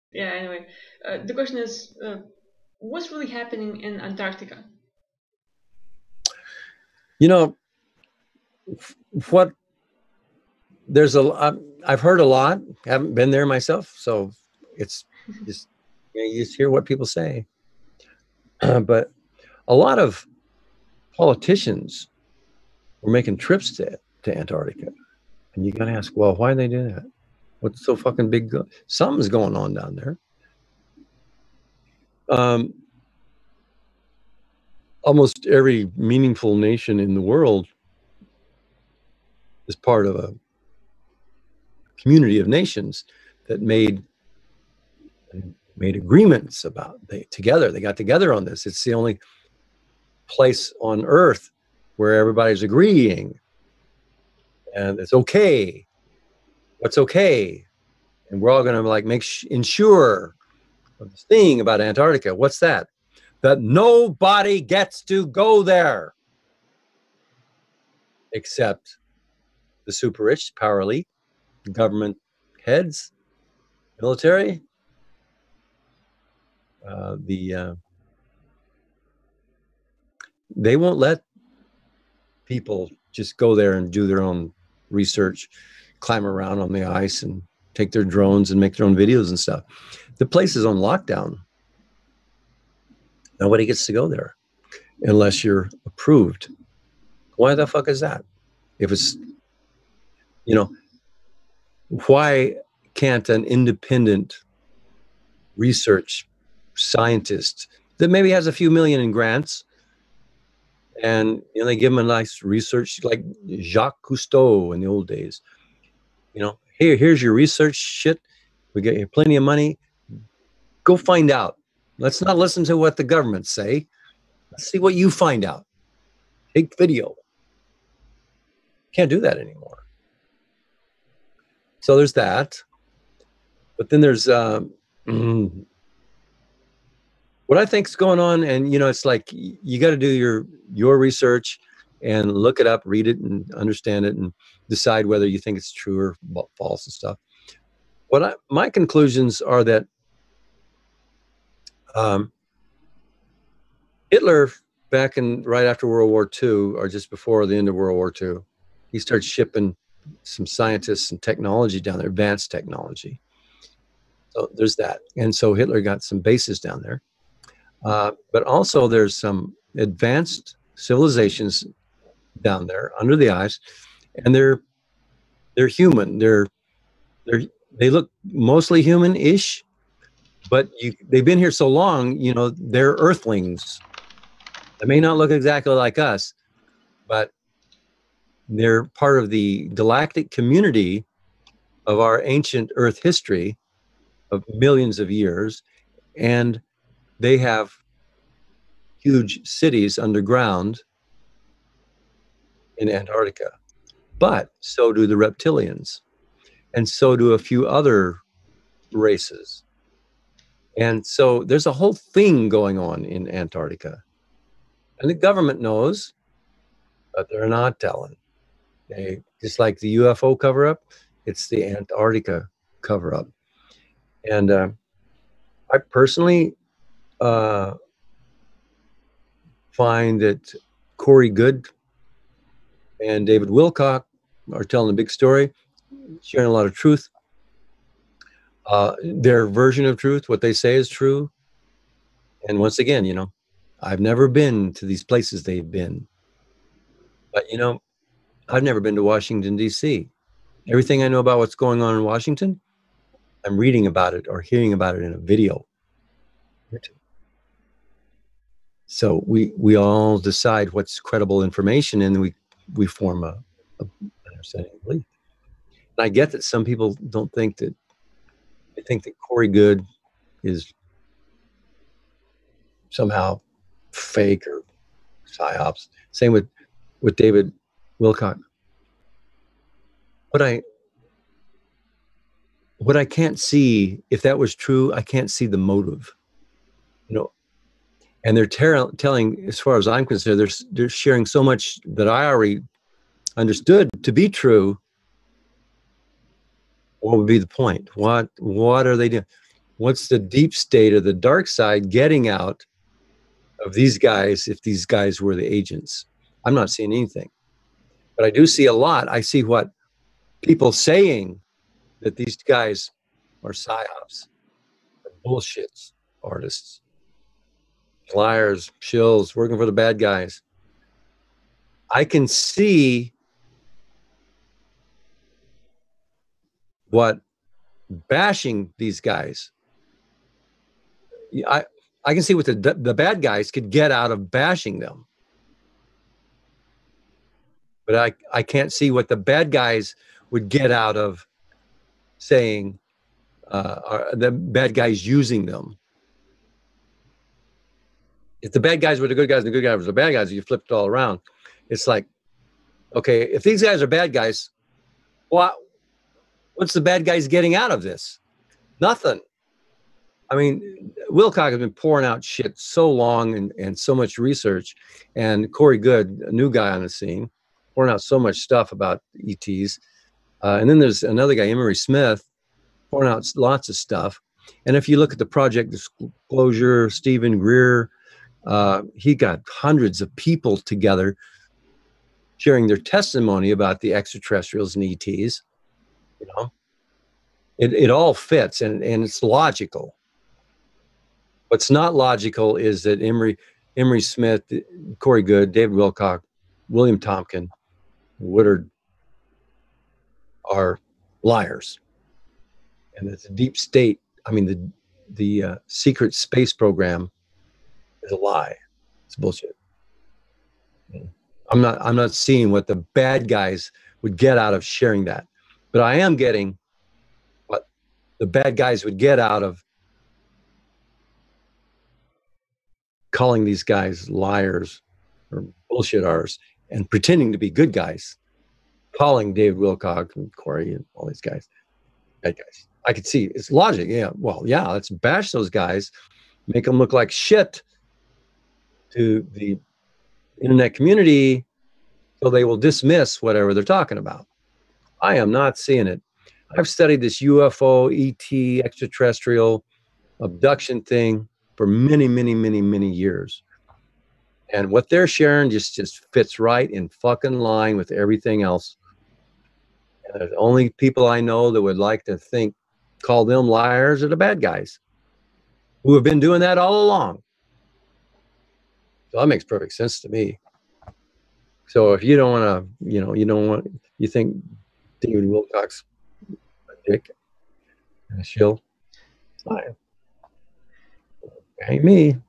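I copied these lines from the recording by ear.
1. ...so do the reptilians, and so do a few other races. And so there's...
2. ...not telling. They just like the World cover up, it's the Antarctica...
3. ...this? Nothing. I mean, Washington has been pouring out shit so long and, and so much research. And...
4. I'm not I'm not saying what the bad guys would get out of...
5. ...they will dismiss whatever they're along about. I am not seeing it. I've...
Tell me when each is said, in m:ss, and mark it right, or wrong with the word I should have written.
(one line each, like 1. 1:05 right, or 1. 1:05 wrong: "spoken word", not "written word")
1. 3:24 right
2. 3:37 wrong: "UFO", not "World"
3. 5:57 wrong: "Wilcock", not "Washington"
4. 6:51 wrong: "seeing", not "saying"
5. 7:22 wrong: "talking", not "along".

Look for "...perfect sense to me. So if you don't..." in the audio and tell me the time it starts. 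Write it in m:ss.
7:49.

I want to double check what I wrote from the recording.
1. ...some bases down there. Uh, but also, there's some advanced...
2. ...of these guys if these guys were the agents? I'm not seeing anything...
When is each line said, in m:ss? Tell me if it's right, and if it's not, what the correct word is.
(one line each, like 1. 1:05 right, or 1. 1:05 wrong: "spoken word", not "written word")
1. 2:46 right
2. 5:03 right.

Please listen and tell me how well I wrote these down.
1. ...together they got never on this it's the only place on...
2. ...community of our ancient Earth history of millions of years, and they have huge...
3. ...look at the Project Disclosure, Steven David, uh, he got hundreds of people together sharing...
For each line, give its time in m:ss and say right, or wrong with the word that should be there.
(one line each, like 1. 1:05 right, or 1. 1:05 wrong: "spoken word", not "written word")
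1. 0:47 wrong: "together", not "never"
2. 3:10 right
3. 6:14 wrong: "Greer", not "David".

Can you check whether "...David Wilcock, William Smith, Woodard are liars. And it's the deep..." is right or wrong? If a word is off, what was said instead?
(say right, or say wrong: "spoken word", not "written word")
wrong: "Tompkin", not "Smith".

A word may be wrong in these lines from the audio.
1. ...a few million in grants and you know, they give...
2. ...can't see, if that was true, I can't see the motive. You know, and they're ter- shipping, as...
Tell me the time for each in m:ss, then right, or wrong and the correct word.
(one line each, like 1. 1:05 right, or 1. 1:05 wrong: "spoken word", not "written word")
1. 1:48 right
2. 4:43 wrong: "telling", not "shipping".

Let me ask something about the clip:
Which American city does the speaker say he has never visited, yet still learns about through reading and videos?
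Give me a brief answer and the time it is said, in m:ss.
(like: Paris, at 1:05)
Washington, D.C., at 4:09.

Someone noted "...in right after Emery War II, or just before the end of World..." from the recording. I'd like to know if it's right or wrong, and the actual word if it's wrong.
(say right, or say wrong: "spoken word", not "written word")
wrong: "World", not "Emery".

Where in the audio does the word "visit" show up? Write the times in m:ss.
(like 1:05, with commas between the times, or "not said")
not said.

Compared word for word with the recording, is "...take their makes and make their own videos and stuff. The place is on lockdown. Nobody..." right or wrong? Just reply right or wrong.
wrong.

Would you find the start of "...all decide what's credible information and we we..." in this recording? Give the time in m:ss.
4:19.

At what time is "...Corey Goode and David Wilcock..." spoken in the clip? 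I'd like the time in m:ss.
3:50.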